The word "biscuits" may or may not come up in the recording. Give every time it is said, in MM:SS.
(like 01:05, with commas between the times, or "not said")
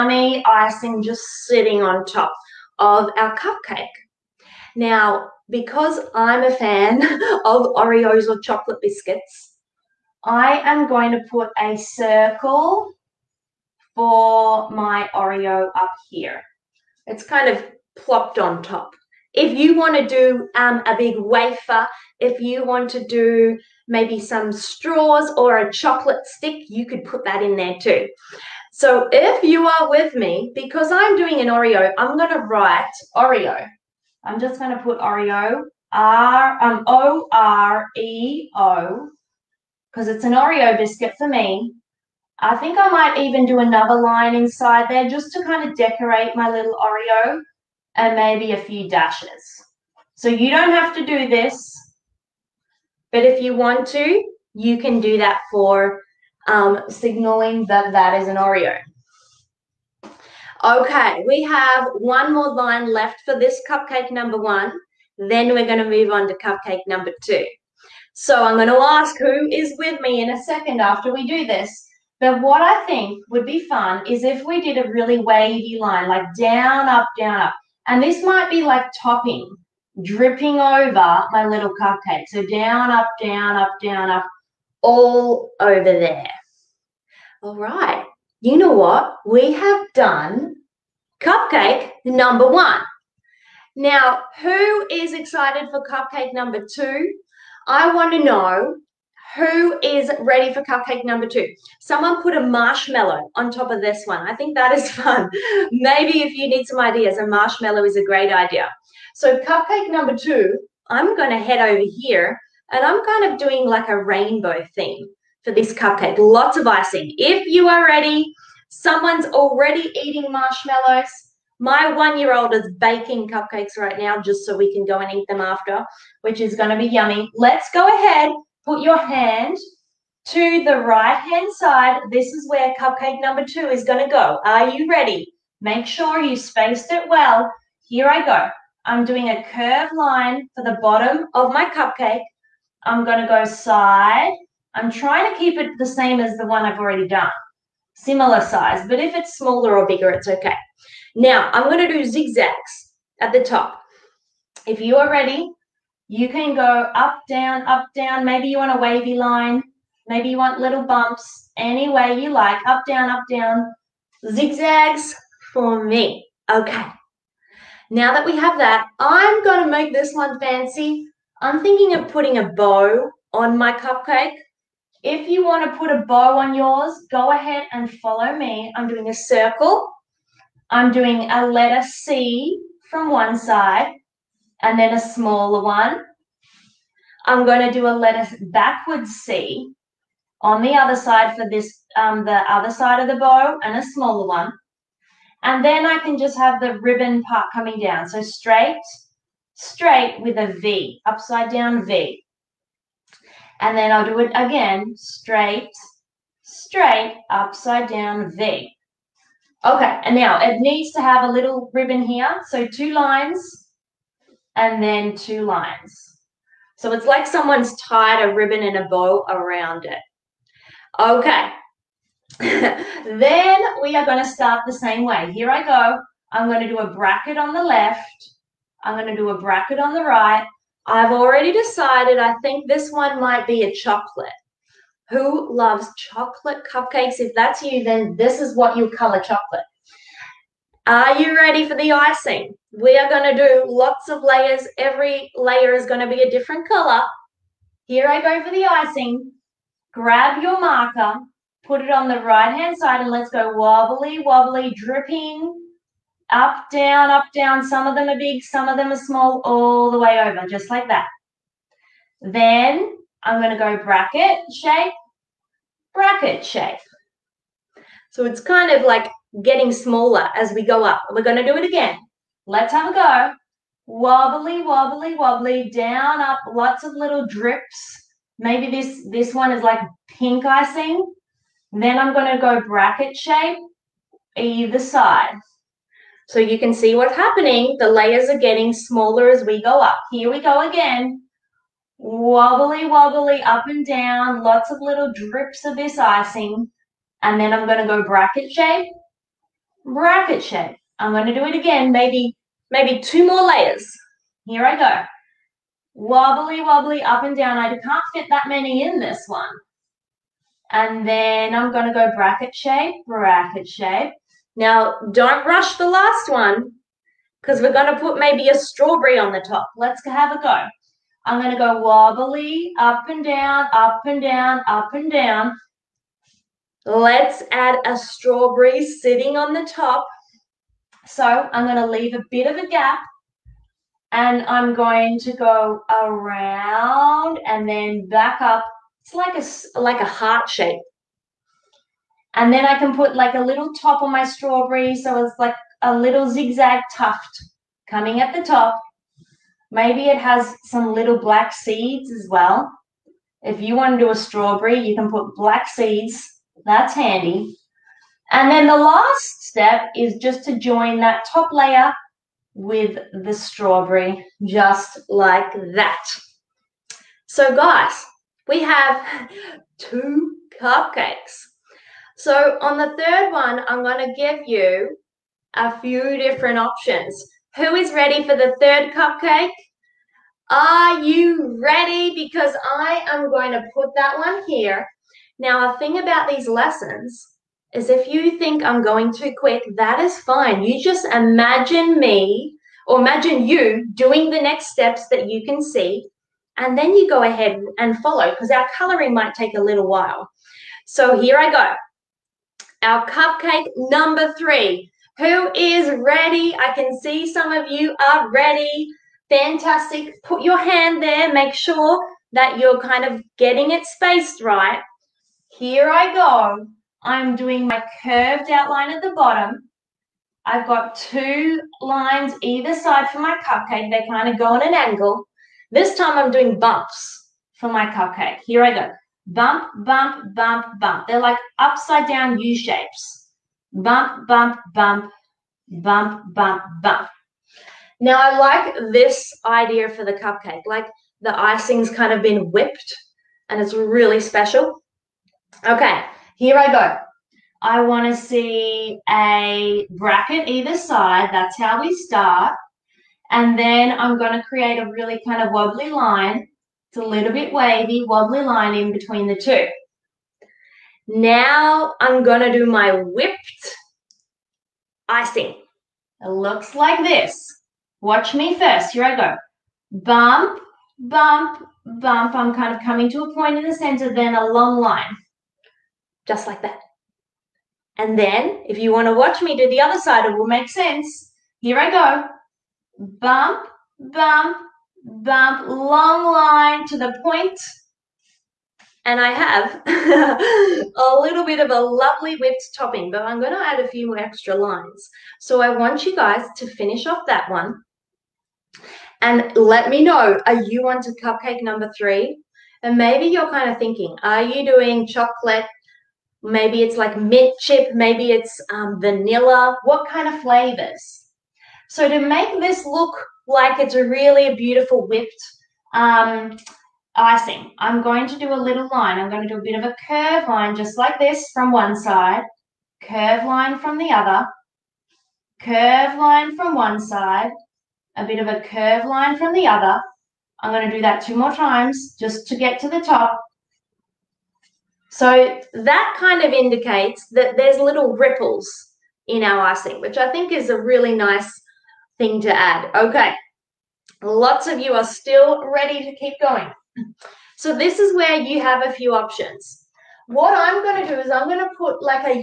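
00:08, 00:40.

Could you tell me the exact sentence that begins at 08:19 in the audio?
And let me know, are you on to cupcake number three?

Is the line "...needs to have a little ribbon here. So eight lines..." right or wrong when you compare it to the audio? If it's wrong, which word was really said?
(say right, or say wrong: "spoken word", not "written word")
wrong: "two", not "eight".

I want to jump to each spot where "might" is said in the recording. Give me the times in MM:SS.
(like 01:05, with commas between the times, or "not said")
00:42, 01:18, 03:53, 06:39.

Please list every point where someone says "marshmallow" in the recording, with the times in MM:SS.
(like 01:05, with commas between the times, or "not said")
01:42, 01:47, 02:00.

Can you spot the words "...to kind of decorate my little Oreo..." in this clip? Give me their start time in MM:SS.
00:45.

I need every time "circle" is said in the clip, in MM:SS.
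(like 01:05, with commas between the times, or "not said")
00:11, 02:59.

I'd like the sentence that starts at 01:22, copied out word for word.
So down, up, down, up, down, up, all over there.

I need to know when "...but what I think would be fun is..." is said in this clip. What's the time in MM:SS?
01:12.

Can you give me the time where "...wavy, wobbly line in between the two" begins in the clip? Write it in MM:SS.
07:37.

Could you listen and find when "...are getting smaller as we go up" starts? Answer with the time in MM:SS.
04:48.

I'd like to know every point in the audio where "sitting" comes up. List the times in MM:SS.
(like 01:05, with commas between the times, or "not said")
00:01, 05:28.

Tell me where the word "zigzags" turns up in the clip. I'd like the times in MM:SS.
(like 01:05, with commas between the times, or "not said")
02:32, 02:44, 05:46.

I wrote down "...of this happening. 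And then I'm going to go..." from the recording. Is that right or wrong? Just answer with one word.
wrong.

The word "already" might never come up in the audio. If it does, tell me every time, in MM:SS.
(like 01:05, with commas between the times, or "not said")
01:59, 02:26, 03:51.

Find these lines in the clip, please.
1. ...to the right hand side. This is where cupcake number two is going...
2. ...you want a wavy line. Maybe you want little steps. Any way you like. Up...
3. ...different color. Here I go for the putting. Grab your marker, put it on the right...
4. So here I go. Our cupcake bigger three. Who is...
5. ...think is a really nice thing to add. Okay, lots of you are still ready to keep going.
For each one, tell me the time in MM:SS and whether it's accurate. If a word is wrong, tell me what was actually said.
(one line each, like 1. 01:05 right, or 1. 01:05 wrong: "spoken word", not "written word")
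1. 02:10 right
2. 02:38 wrong: "bumps", not "steps"
3. 04:06 wrong: "icing", not "putting"
4. 06:40 wrong: "number", not "bigger"
5. 09:00 right.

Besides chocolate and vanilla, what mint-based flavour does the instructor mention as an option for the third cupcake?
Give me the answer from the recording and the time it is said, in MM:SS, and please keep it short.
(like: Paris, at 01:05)
Mint chip, at 08:27.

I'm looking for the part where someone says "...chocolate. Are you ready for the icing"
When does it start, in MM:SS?
03:59.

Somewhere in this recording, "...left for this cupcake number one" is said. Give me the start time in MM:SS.
01:02.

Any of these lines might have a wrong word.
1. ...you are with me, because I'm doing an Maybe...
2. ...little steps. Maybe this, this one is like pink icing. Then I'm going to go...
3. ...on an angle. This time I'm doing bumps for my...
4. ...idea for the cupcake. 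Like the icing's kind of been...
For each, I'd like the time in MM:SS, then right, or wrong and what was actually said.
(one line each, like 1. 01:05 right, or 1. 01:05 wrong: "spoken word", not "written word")
1. 00:29 wrong: "Oreo", not "Maybe"
2. 04:36 wrong: "drips", not "steps"
3. 07:04 right
4. 07:19 right.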